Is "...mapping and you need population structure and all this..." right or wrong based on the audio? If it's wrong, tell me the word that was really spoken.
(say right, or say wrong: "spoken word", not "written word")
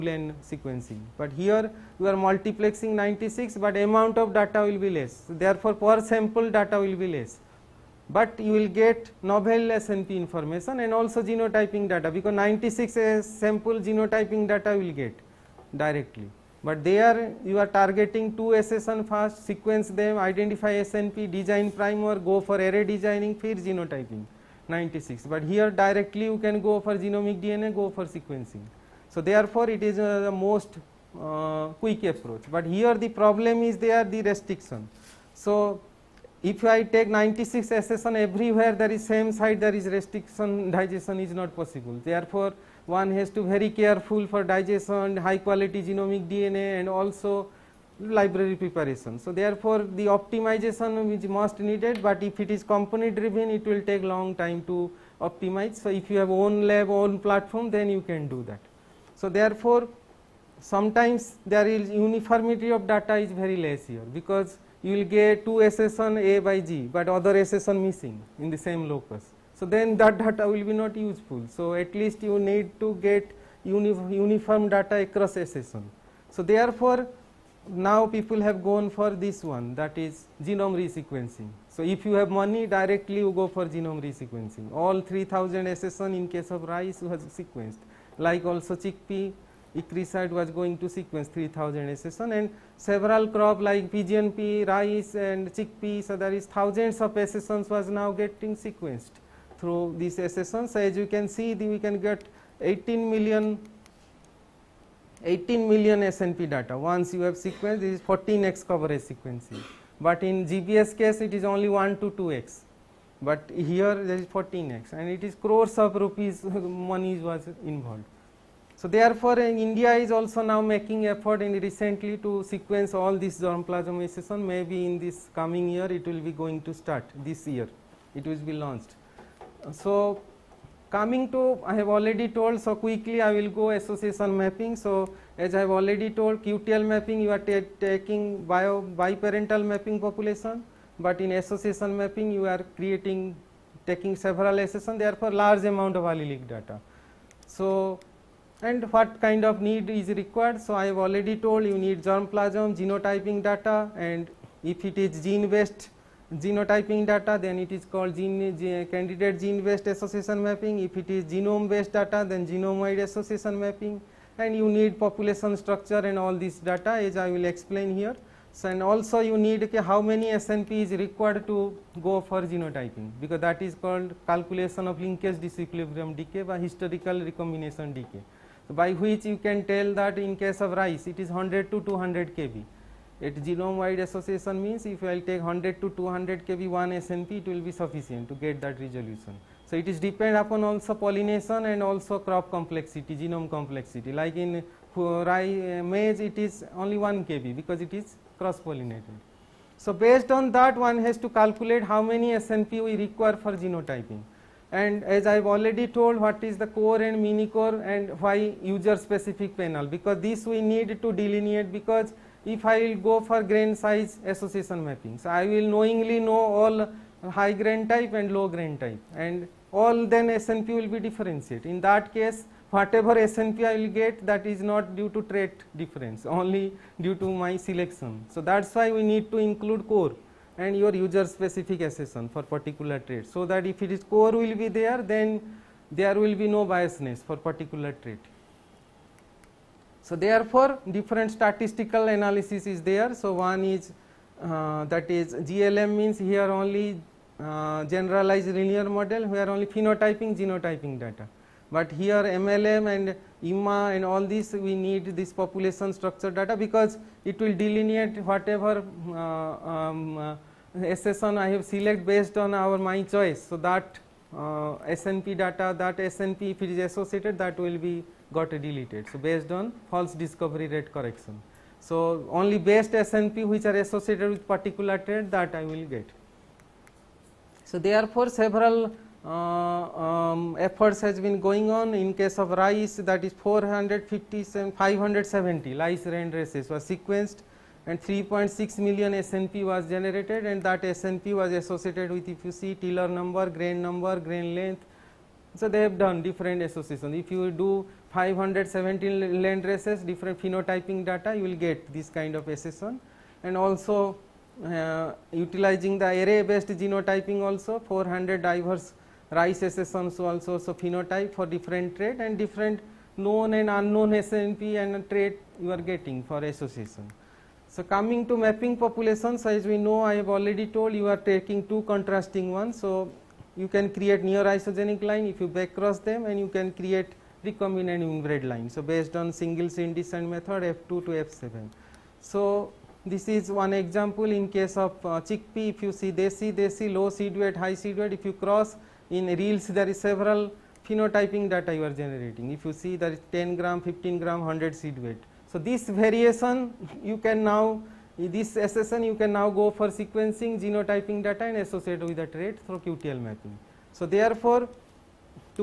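right.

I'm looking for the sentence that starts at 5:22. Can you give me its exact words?
So, you can create near isogenic line if you back cross them and you can create recombinant inbred line.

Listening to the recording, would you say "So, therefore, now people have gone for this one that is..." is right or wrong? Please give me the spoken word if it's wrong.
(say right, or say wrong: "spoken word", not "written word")
right.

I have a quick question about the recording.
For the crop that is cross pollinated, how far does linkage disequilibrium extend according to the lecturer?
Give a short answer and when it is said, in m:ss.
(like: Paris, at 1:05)
1 kb, at 3:16.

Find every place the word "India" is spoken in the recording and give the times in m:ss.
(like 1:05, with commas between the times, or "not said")
1:59.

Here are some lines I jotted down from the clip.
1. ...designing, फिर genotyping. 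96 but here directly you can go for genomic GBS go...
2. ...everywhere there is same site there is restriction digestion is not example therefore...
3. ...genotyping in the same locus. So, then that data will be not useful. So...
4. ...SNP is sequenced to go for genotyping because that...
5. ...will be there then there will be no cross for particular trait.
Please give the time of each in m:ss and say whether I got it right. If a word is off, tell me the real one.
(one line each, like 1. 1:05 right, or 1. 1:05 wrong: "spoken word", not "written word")
1. 0:22 wrong: "DNA", not "GBS"
2. 0:38 wrong: "possible", not "example"
3. 1:07 wrong: "missing", not "genotyping"
4. 2:50 wrong: "required", not "sequenced"
5. 3:54 wrong: "biasness", not "cross".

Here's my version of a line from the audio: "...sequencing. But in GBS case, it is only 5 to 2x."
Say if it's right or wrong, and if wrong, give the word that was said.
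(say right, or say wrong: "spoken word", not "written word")
wrong: "1", not "5".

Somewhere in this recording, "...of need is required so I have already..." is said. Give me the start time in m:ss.
2:29.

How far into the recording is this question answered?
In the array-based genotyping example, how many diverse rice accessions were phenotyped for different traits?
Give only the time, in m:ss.
5:07.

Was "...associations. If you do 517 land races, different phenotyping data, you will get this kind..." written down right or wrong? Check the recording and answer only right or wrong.
right.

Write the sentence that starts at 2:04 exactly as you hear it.
Maybe in this coming year, it will be going to start this year.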